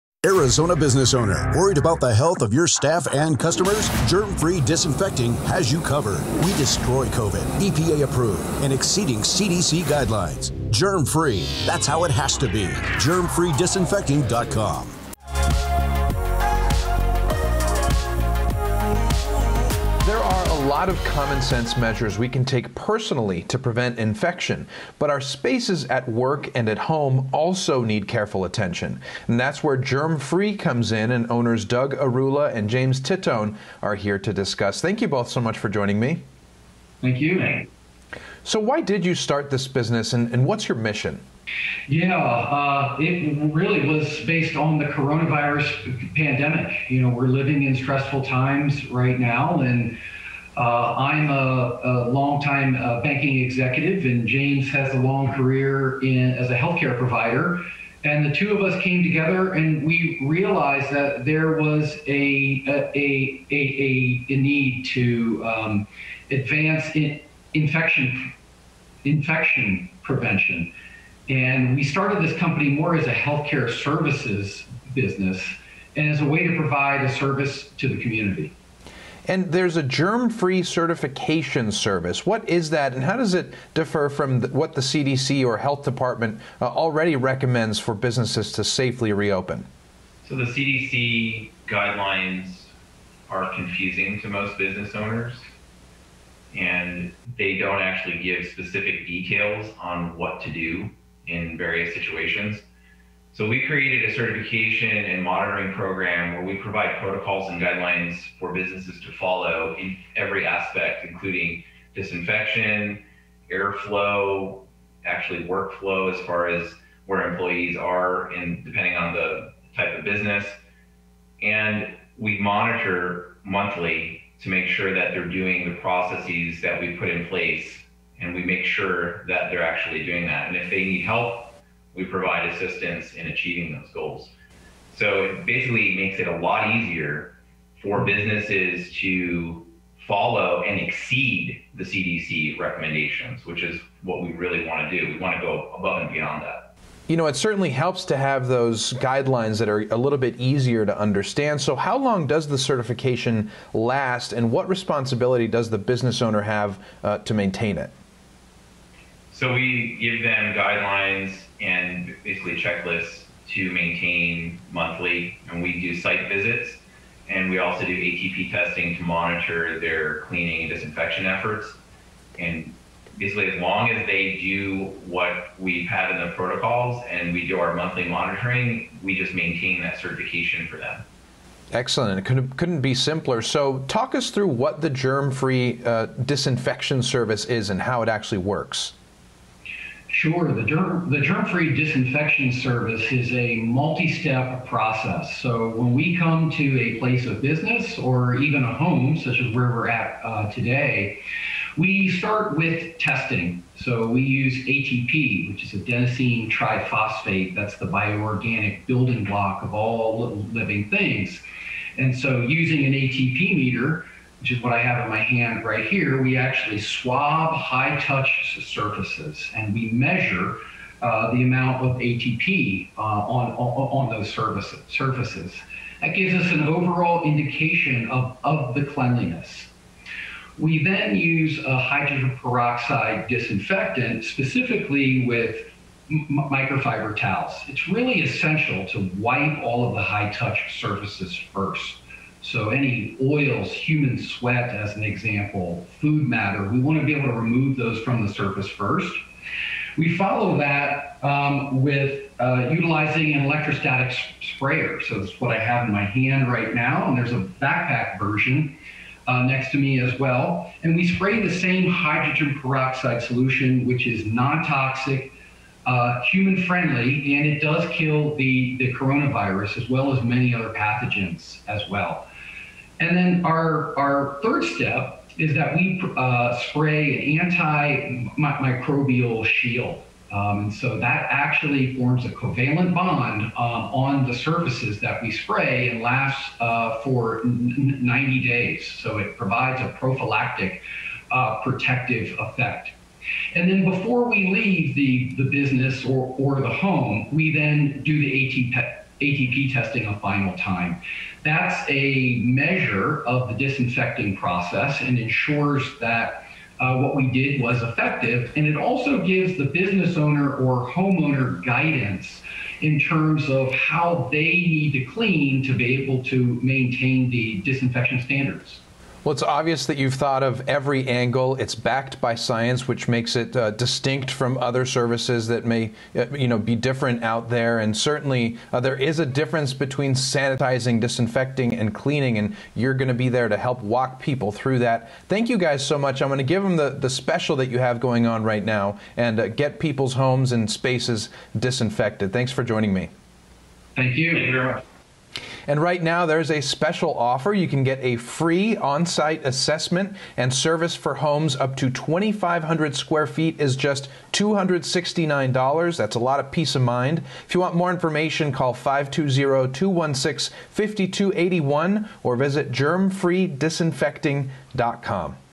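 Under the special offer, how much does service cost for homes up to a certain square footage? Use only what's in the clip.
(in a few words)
$269.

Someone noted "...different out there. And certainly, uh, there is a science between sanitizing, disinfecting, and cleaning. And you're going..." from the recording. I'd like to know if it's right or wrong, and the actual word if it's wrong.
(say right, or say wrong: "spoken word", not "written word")
wrong: "difference", not "science".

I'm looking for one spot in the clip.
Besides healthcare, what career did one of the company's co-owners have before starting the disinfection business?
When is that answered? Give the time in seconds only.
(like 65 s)
53 s.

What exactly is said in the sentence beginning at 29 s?
And that's where Germ Free comes in, and owners Doug Airulla and James Titone are here to discuss.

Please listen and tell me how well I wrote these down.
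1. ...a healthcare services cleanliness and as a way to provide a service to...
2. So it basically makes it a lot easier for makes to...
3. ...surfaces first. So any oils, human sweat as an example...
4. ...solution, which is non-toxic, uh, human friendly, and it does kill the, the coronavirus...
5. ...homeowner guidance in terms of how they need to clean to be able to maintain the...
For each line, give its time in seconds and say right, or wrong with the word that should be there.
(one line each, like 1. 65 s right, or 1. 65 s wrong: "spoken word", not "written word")
1. 73 s wrong: "business", not "cleanliness"
2. 134 s wrong: "businesses", not "makes"
3. 240 s right
4. 263 s right
5. 310 s right.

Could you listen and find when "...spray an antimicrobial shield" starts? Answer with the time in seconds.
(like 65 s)
276 s.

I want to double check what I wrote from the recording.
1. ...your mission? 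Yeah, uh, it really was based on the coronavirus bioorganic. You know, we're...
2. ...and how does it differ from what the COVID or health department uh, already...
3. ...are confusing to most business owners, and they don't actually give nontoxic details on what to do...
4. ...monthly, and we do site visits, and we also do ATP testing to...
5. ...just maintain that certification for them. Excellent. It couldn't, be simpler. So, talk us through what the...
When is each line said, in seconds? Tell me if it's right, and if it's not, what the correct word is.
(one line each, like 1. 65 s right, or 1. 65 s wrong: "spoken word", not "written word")
1. 40 s wrong: "pandemic", not "bioorganic"
2. 82 s wrong: "CDC", not "COVID"
3. 93 s wrong: "specific", not "nontoxic"
4. 164 s right
5. 179 s right.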